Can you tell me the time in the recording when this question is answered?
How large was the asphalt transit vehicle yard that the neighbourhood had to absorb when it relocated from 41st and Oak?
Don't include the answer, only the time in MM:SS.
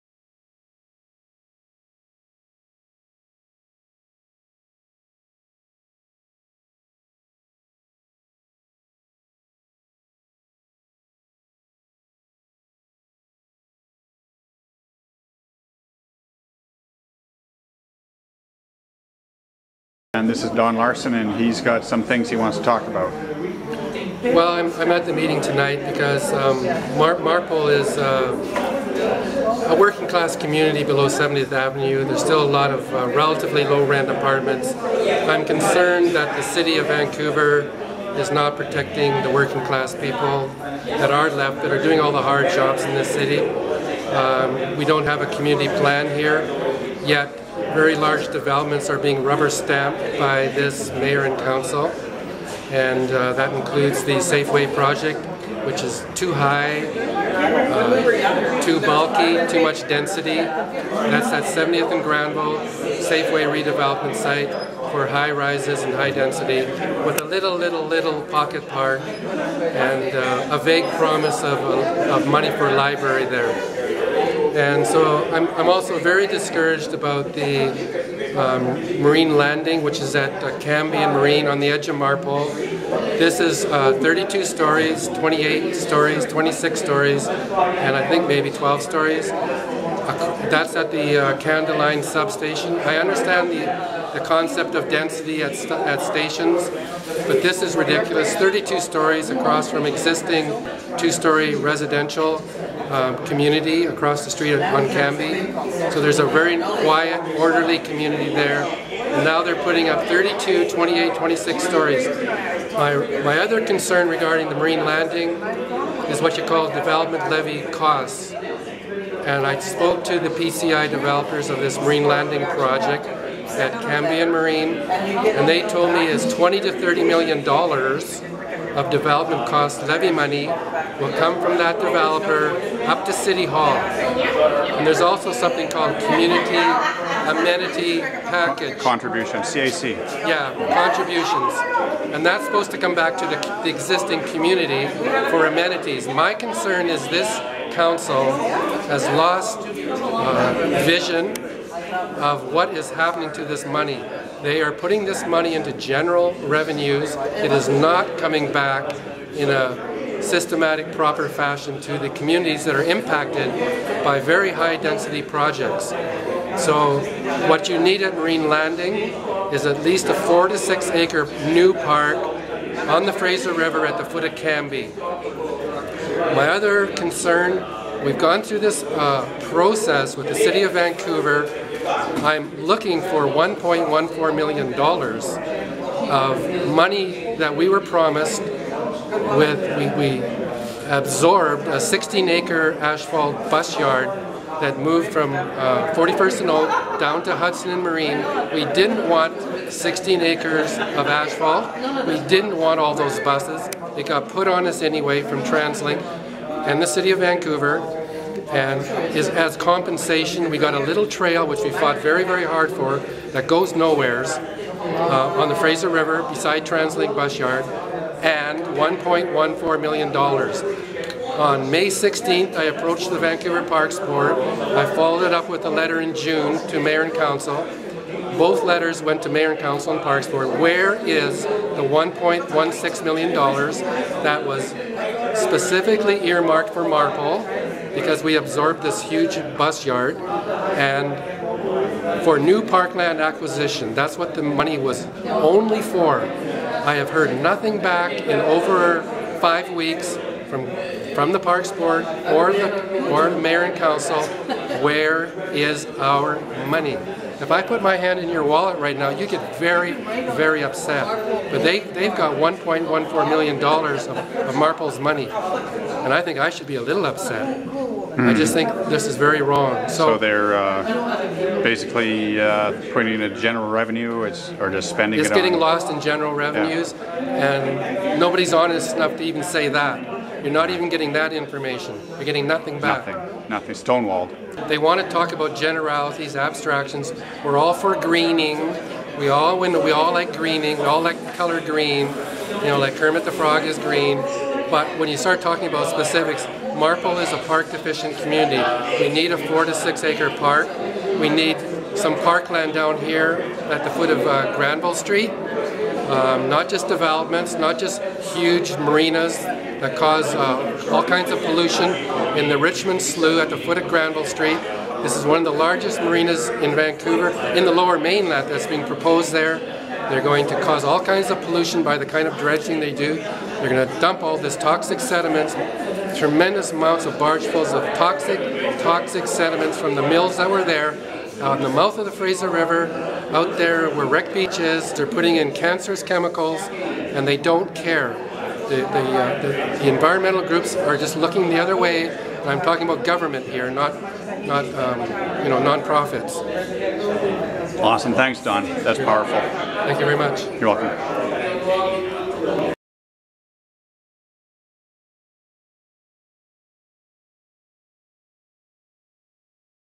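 03:11.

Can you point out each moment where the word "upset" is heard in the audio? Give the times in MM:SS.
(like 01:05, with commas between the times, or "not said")
04:20, 04:27.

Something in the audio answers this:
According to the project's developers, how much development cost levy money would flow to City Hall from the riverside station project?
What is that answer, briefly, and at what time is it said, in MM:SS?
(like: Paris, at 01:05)
$20 to $30 million, at 02:06.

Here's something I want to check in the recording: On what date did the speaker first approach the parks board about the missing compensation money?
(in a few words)
May 16.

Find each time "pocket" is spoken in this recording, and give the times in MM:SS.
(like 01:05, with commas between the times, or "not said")
01:08.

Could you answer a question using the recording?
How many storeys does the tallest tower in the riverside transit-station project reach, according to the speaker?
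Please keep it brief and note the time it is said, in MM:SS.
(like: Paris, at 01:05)
32, at 01:24.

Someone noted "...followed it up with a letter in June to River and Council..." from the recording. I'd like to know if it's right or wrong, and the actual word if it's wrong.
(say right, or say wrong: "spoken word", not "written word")
wrong: "Mayor", not "River".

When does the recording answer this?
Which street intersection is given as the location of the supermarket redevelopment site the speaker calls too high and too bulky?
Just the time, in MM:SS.
01:01.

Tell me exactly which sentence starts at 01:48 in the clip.
And now they're putting up 32, 28, 26 stories.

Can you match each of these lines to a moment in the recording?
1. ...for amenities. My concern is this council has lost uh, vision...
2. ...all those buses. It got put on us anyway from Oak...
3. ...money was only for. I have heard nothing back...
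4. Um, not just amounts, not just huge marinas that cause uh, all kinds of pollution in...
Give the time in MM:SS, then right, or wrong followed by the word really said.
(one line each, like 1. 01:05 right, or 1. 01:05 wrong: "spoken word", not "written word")
1. 02:25 right
2. 03:22 wrong: "TransLink", not "Oak"
3. 04:04 right
4. 05:05 wrong: "developments", not "amounts".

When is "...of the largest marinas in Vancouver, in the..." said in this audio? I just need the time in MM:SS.
05:15.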